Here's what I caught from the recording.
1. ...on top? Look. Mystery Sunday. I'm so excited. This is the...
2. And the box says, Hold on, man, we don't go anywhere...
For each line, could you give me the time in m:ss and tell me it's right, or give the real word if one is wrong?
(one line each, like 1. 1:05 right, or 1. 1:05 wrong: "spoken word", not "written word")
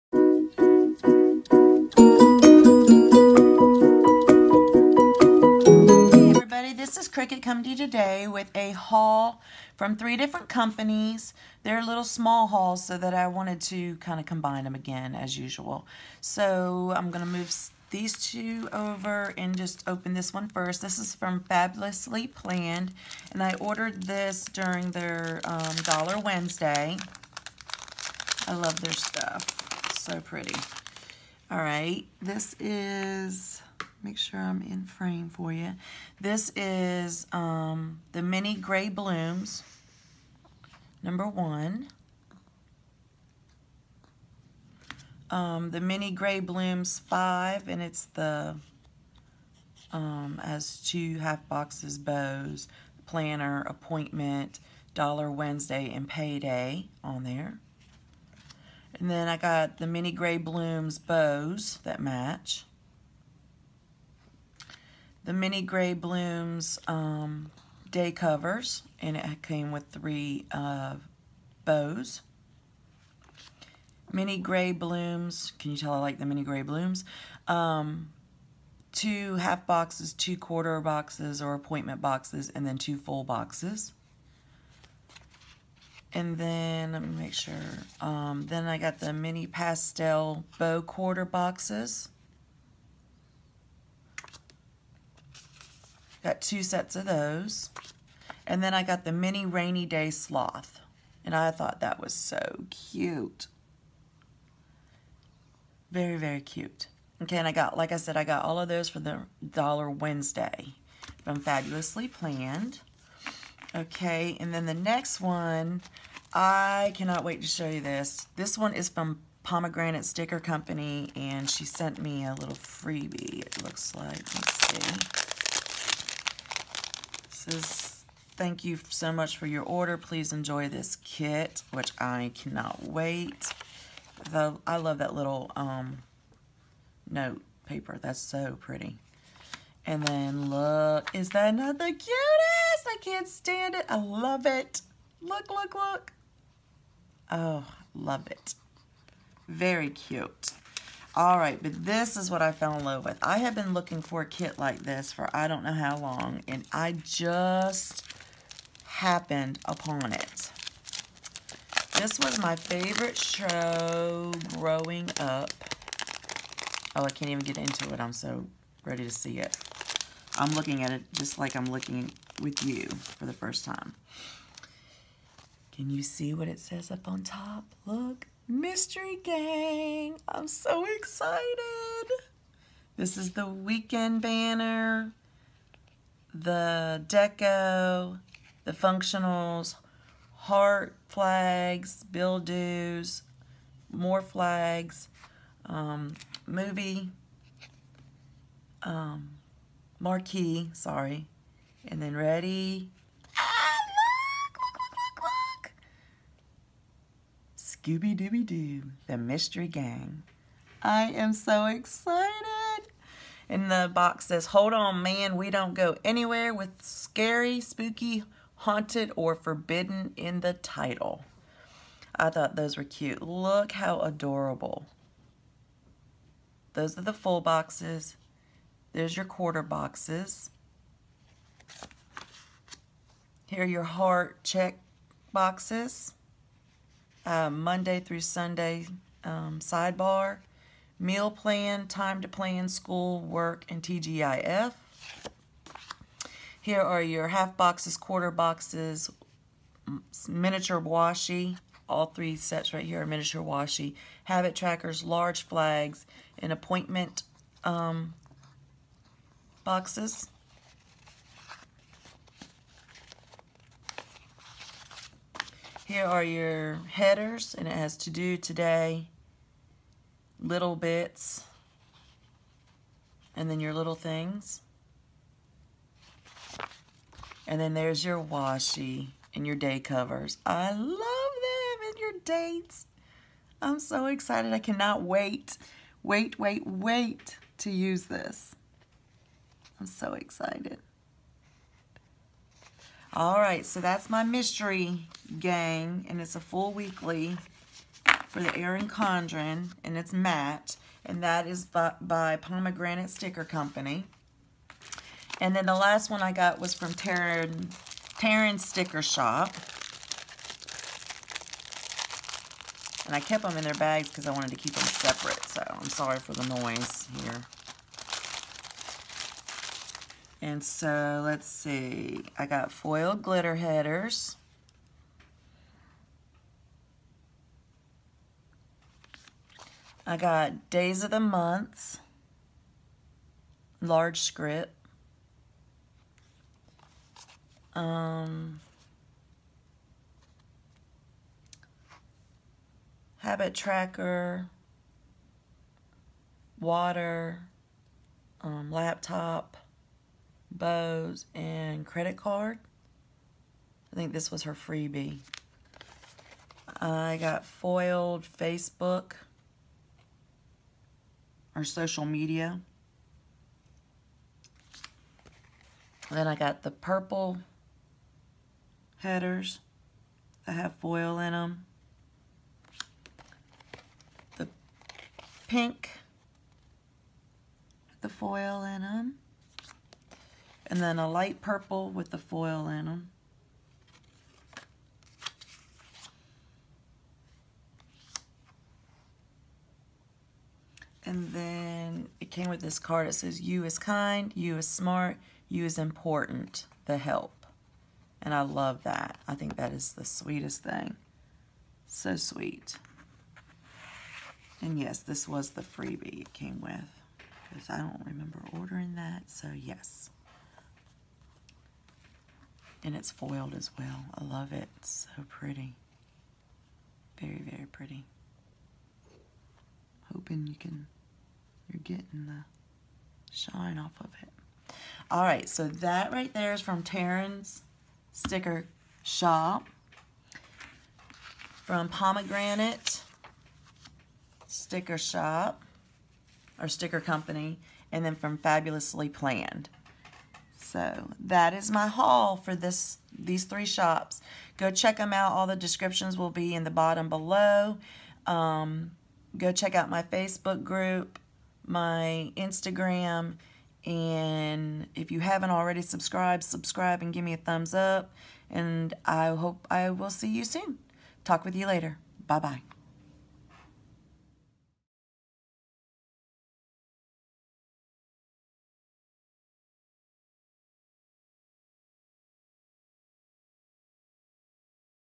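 1. 2:57 wrong: "Gang", not "Sunday"
2. 3:33 right.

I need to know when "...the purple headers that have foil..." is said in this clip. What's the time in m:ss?
6:06.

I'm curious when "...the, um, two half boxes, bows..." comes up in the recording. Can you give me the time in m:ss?
0:48.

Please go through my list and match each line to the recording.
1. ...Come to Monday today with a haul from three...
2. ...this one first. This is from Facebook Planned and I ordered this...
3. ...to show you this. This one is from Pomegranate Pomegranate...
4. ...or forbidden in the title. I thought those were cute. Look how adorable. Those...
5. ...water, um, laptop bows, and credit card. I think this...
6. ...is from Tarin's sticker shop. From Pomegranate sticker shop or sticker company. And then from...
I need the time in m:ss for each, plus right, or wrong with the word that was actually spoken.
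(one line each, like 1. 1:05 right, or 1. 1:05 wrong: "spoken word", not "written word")
1. 0:07 wrong: "You", not "Monday"
2. 0:20 wrong: "Fabulously", not "Facebook"
3. 1:57 wrong: "Sticker", not "Pomegranate"
4. 3:39 right
5. 5:46 right
6. 7:06 right.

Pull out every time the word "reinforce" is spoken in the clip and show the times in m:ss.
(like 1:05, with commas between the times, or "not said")
not said.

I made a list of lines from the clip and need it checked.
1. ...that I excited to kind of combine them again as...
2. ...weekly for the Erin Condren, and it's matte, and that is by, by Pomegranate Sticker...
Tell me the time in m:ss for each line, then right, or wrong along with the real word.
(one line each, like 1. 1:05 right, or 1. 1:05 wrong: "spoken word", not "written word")
1. 0:12 wrong: "wanted", not "excited"
2. 4:56 right.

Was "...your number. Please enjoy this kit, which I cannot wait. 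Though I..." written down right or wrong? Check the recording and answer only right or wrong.
wrong.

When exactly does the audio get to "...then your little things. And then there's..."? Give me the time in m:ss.
4:33.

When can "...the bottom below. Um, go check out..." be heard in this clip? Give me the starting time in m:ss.
7:26.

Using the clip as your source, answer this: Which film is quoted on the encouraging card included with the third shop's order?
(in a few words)
The Help.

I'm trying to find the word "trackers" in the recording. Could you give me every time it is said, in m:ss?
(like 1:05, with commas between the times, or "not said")
4:14, 5:43.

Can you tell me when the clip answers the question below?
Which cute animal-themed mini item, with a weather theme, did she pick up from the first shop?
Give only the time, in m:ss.
1:39.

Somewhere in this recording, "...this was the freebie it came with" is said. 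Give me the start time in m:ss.
6:44.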